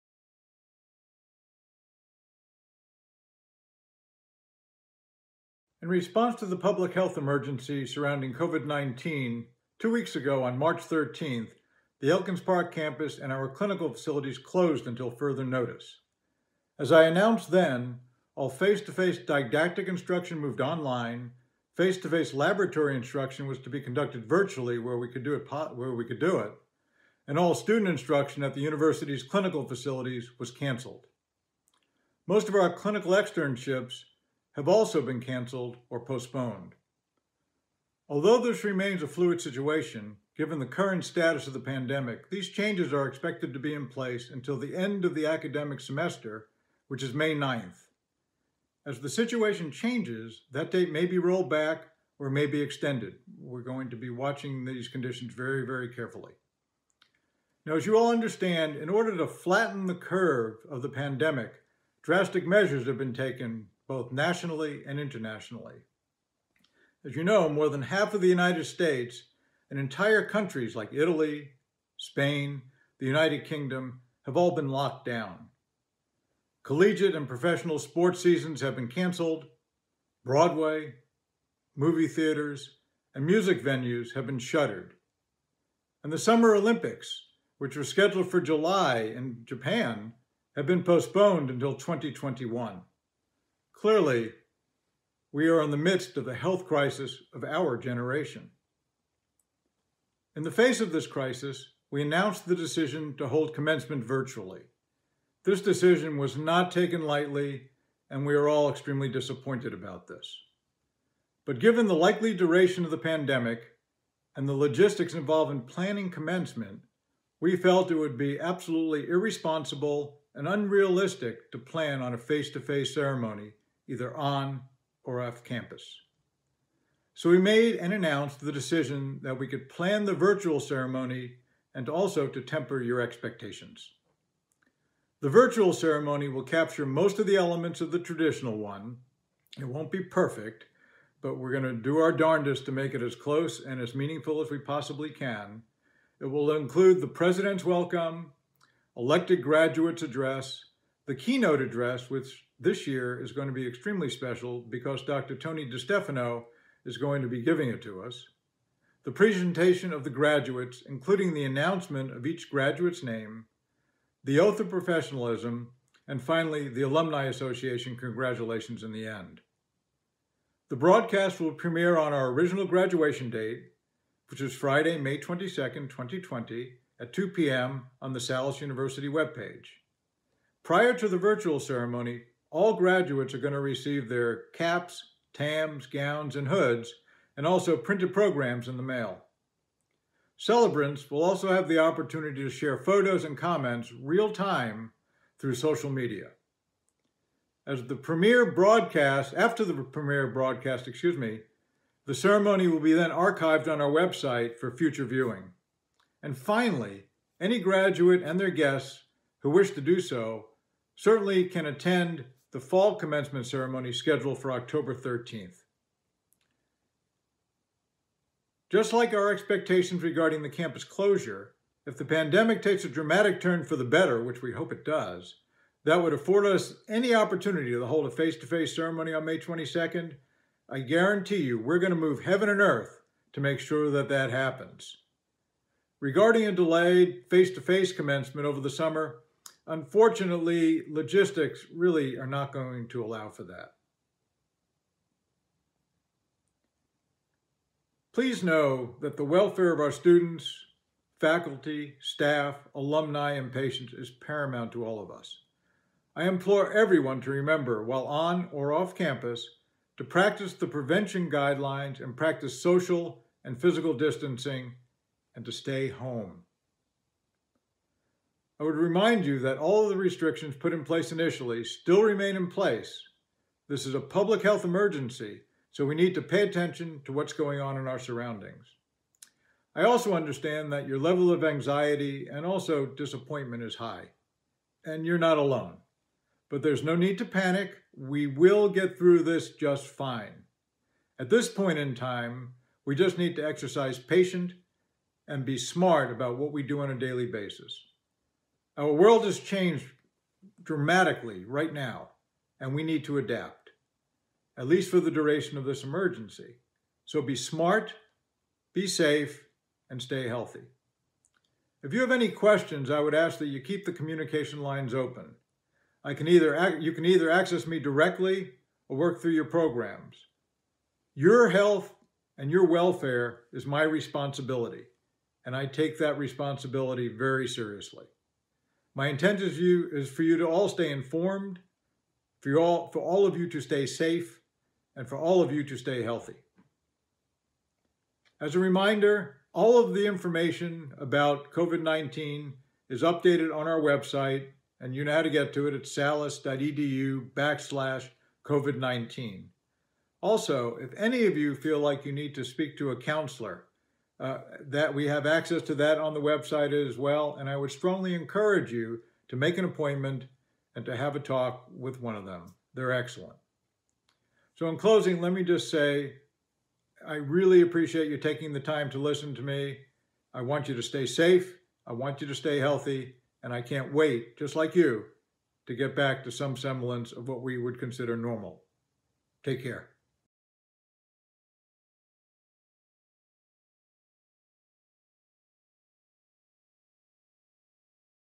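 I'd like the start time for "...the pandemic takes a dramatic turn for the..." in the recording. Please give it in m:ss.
3:41.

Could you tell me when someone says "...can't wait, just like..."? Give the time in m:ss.
6:13.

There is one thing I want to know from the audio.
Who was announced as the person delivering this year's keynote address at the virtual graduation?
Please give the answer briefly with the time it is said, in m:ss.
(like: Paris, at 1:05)
Dr. Tony DiStefano, at 2:35.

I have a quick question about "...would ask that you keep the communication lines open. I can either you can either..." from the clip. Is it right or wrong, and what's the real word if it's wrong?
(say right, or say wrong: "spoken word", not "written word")
right.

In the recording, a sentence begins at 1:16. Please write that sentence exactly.
Collegiate and professional sports seasons have been canceled.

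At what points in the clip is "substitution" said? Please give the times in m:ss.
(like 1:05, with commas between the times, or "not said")
not said.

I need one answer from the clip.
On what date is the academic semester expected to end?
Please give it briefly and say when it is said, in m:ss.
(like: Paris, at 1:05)
May 9, at 0:47.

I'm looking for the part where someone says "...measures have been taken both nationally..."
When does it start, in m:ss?
1:02.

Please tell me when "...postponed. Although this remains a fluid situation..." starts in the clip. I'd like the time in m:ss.
0:35.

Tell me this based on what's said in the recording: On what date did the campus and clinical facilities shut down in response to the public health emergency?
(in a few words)
March 13.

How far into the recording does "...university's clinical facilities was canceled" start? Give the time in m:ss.
0:28.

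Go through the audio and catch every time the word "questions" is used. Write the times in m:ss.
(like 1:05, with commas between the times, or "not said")
5:12.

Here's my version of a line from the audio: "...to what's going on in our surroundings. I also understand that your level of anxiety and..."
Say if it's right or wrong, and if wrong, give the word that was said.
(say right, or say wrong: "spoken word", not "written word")
right.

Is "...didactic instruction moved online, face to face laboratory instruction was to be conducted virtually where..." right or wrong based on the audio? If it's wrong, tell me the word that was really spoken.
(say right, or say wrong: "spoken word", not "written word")
right.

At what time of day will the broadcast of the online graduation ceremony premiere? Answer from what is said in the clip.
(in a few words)
2 p.m.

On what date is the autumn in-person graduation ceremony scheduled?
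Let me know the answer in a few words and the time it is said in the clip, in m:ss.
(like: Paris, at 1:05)
October 13, at 3:34.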